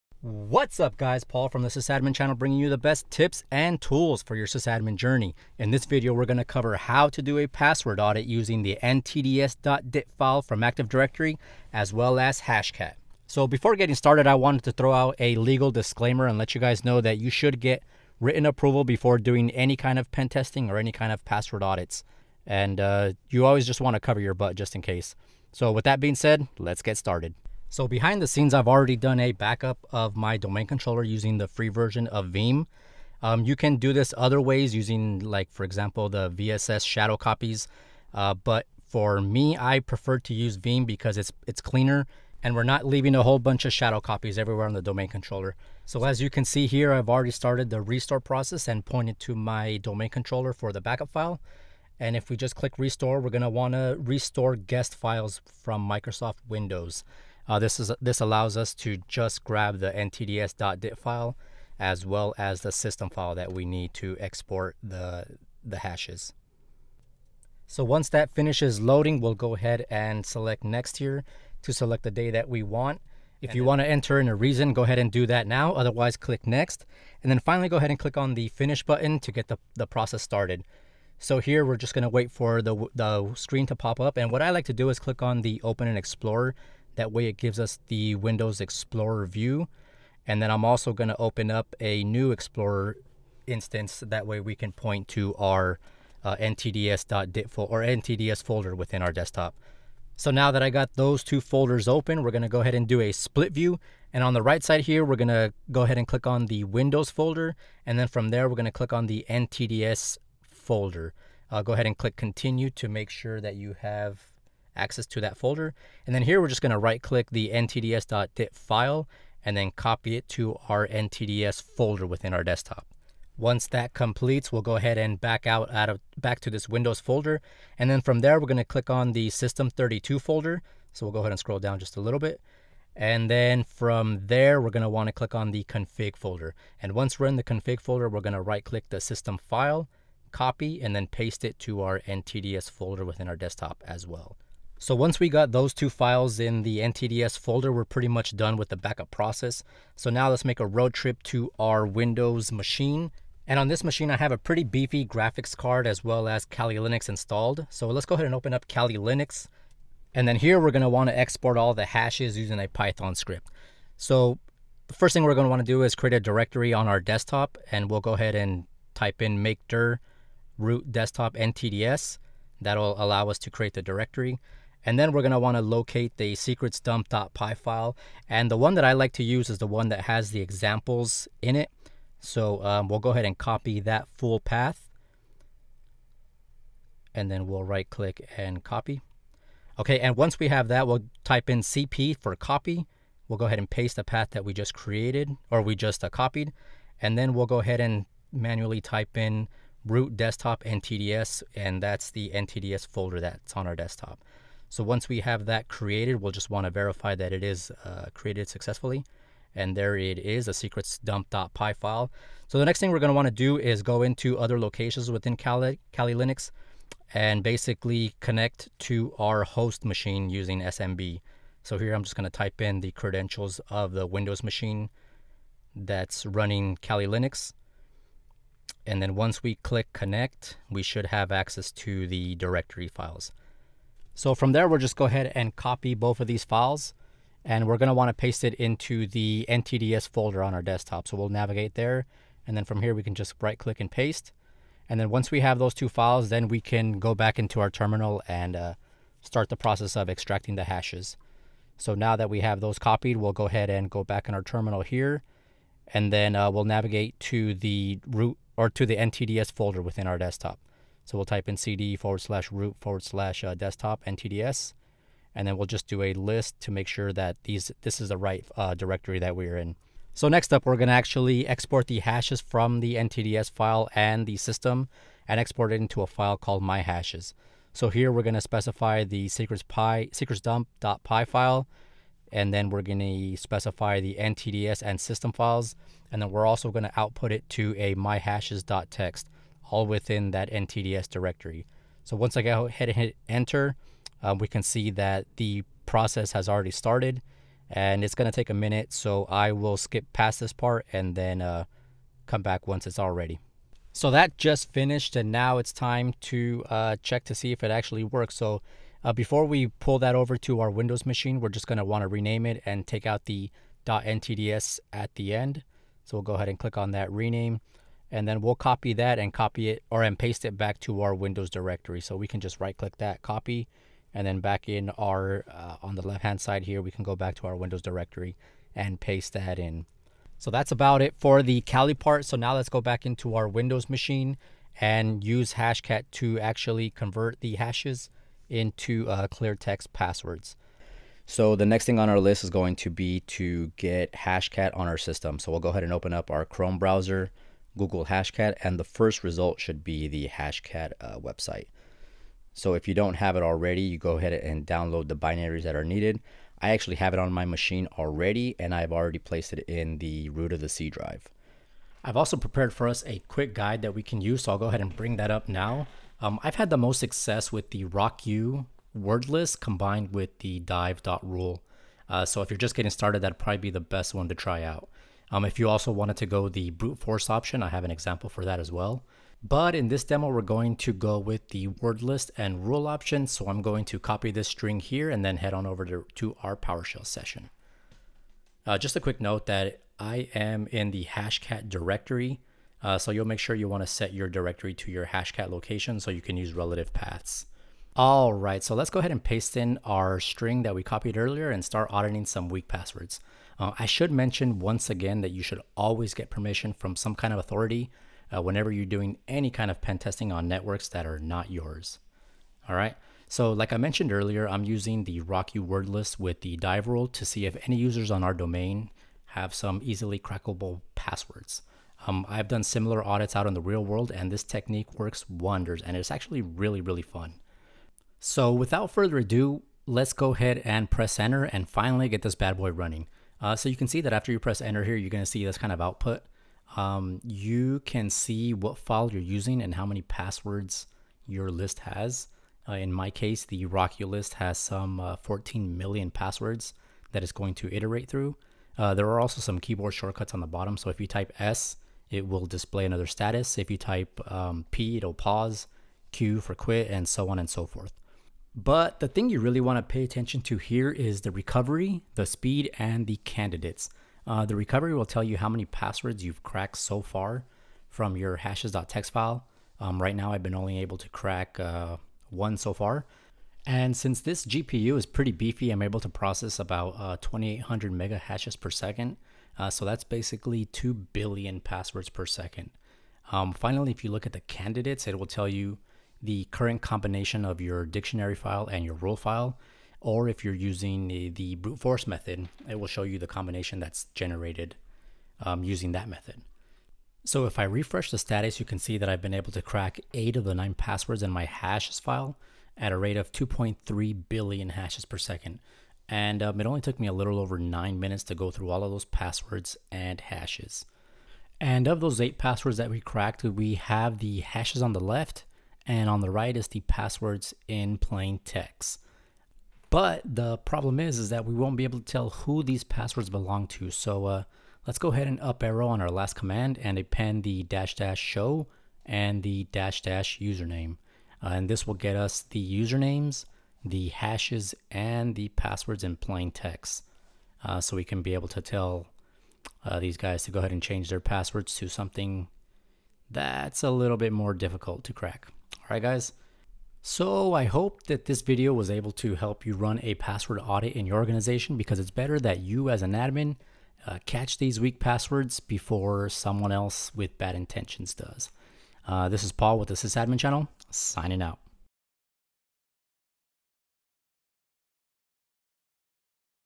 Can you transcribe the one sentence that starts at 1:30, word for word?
And then I'm also gonna open up a new Explorer instance.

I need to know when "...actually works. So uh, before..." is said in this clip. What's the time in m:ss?
5:07.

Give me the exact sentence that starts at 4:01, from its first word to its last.
So we'll navigate there and then from here we can just right click and paste.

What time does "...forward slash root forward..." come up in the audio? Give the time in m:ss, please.
4:21.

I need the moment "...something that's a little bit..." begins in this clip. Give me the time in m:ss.
9:01.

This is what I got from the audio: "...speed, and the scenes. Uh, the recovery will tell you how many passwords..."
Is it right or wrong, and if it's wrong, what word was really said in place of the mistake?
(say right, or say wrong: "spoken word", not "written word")
wrong: "candidates", not "scenes".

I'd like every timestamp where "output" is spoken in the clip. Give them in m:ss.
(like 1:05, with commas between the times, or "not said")
4:46, 7:15.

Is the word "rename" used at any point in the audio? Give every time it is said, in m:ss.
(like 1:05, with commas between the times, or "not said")
5:12, 5:17.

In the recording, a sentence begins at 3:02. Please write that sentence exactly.
So um, we'll go ahead and copy that full path.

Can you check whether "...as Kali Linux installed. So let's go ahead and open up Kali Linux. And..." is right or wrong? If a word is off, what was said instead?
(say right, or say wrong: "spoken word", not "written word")
right.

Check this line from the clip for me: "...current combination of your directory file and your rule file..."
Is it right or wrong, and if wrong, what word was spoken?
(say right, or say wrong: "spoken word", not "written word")
wrong: "dictionary", not "directory".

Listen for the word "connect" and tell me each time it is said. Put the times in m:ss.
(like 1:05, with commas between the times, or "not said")
3:38, 3:49.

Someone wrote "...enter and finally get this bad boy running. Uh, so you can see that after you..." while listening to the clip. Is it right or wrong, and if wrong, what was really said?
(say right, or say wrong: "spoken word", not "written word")
right.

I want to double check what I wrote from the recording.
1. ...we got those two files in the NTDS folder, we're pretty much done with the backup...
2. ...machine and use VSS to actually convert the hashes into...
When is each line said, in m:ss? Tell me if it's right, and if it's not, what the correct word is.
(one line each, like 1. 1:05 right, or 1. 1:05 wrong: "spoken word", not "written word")
1. 2:25 right
2. 5:33 wrong: "Hashcat", not "VSS".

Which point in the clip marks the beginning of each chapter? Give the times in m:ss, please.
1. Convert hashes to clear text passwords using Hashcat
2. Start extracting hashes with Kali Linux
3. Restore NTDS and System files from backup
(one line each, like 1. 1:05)
1. 5:29
2. 2:30
3. 0:27.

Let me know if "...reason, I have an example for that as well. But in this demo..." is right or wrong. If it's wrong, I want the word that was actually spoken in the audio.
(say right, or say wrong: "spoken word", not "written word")
wrong: "option", not "reason".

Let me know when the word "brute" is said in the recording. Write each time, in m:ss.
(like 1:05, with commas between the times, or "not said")
6:16, 8:11.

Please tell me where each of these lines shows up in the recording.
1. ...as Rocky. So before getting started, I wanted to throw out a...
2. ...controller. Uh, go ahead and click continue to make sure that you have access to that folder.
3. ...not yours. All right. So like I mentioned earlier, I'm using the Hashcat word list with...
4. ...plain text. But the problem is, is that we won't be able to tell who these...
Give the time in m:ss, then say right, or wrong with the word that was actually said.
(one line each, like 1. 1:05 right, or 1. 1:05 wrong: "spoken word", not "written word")
1. 0:12 wrong: "Hashcat", not "Rocky"
2. 1:50 wrong: "folder", not "controller"
3. 6:51 wrong: "Rocky", not "Hashcat"
4. 8:37 right.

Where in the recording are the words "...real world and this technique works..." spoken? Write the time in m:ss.
7:03.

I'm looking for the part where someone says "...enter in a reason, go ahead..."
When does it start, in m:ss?
1:13.